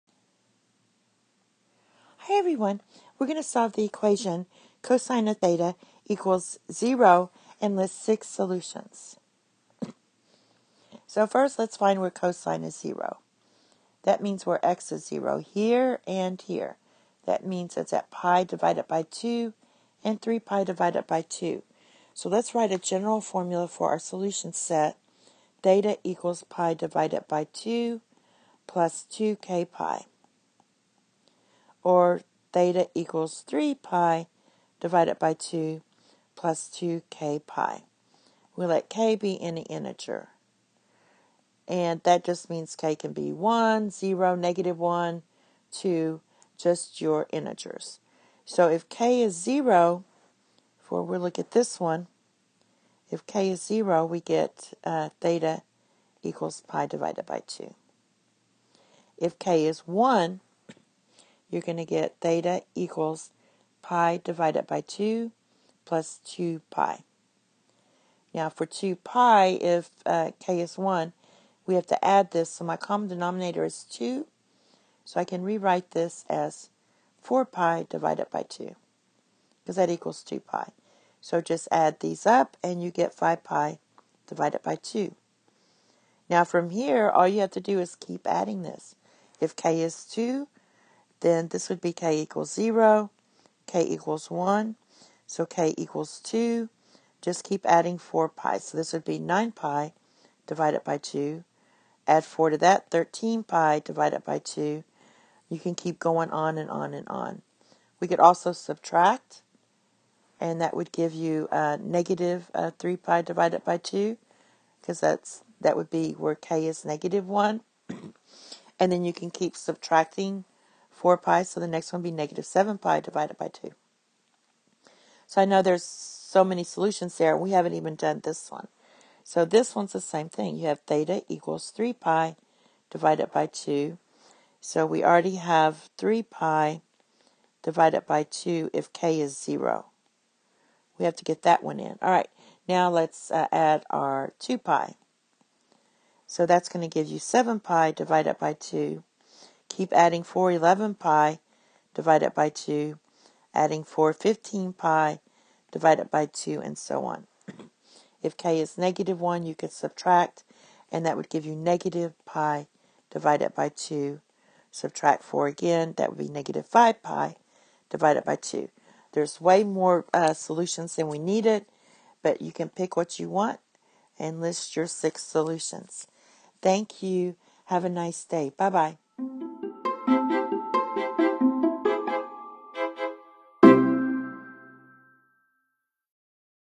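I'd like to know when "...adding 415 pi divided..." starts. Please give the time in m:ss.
2:33.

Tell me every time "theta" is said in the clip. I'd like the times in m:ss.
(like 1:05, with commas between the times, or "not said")
0:05, 0:25, 0:32, 0:55, 1:02, 2:10.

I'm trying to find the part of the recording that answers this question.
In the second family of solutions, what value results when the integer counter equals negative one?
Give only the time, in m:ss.
2:41.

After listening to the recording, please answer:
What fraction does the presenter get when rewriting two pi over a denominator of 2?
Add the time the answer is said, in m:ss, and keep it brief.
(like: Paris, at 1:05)
4 pi/2, at 1:17.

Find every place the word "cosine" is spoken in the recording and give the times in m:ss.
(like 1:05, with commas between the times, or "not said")
0:04, 0:12.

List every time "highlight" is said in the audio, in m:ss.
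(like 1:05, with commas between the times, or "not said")
not said.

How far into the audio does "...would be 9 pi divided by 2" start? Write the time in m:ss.
1:38.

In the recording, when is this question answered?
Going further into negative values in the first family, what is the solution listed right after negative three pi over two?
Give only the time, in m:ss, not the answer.
2:02.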